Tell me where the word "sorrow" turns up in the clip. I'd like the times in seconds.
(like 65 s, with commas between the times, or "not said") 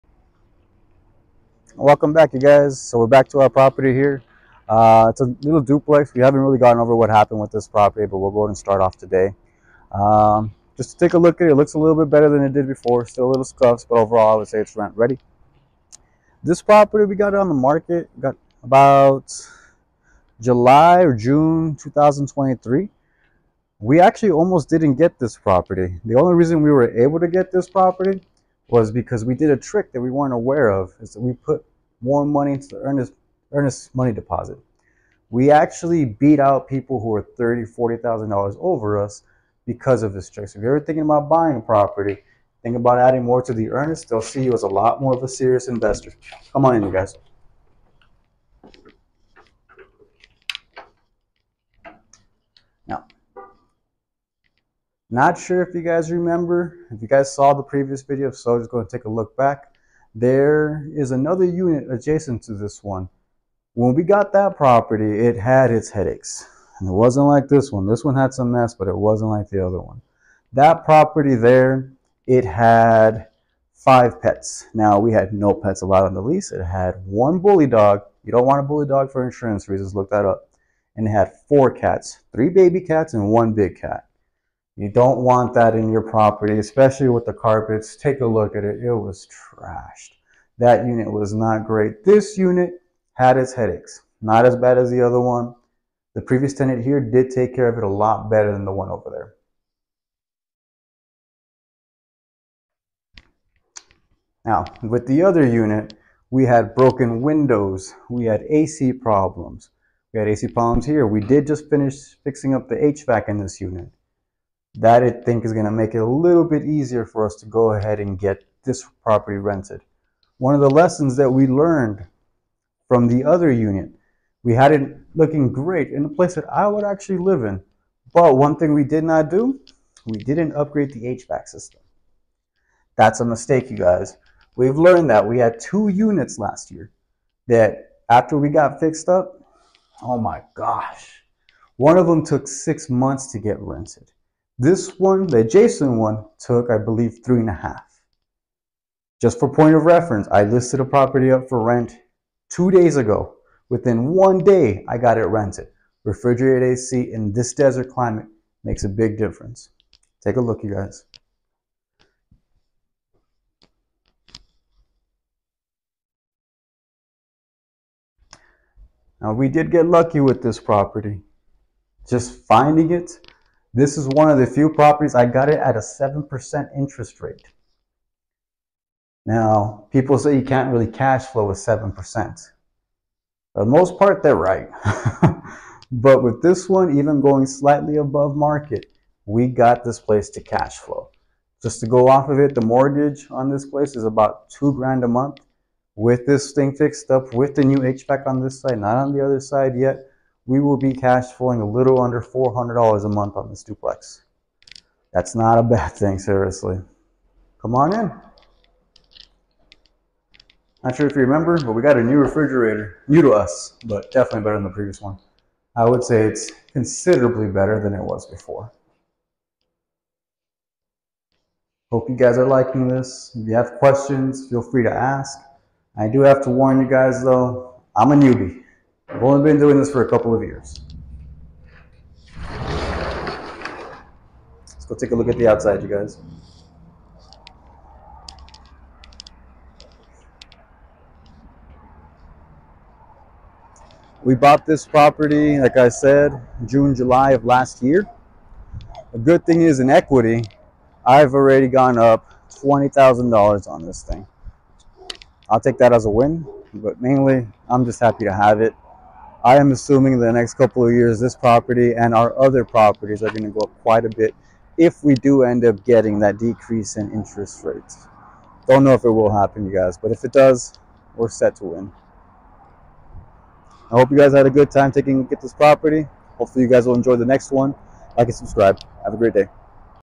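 not said.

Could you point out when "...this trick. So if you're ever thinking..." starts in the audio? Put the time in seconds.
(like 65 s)
40 s.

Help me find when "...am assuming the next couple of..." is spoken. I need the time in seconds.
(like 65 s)
259 s.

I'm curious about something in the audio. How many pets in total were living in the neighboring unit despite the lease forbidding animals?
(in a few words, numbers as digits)
5.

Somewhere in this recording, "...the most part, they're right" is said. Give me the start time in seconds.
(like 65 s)
183 s.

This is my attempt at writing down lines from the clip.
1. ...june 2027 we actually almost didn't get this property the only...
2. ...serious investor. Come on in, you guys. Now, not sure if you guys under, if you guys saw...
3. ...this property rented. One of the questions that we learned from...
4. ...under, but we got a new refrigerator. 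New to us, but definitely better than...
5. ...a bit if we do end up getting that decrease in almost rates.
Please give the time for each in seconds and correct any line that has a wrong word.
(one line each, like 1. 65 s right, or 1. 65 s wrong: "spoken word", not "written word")
1. 21 s wrong: "2023", not "2027"
2. 45 s wrong: "remember", not "under"
3. 118 s wrong: "lessons", not "questions"
4. 211 s wrong: "remember", not "under"
5. 264 s wrong: "interest", not "almost".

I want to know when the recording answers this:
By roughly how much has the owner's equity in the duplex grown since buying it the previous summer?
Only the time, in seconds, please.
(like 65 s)
252 s.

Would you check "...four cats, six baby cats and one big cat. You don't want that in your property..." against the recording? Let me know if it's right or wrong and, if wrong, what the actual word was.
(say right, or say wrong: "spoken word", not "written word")
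wrong: "three", not "six".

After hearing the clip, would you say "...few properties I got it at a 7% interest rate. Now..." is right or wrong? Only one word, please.
right.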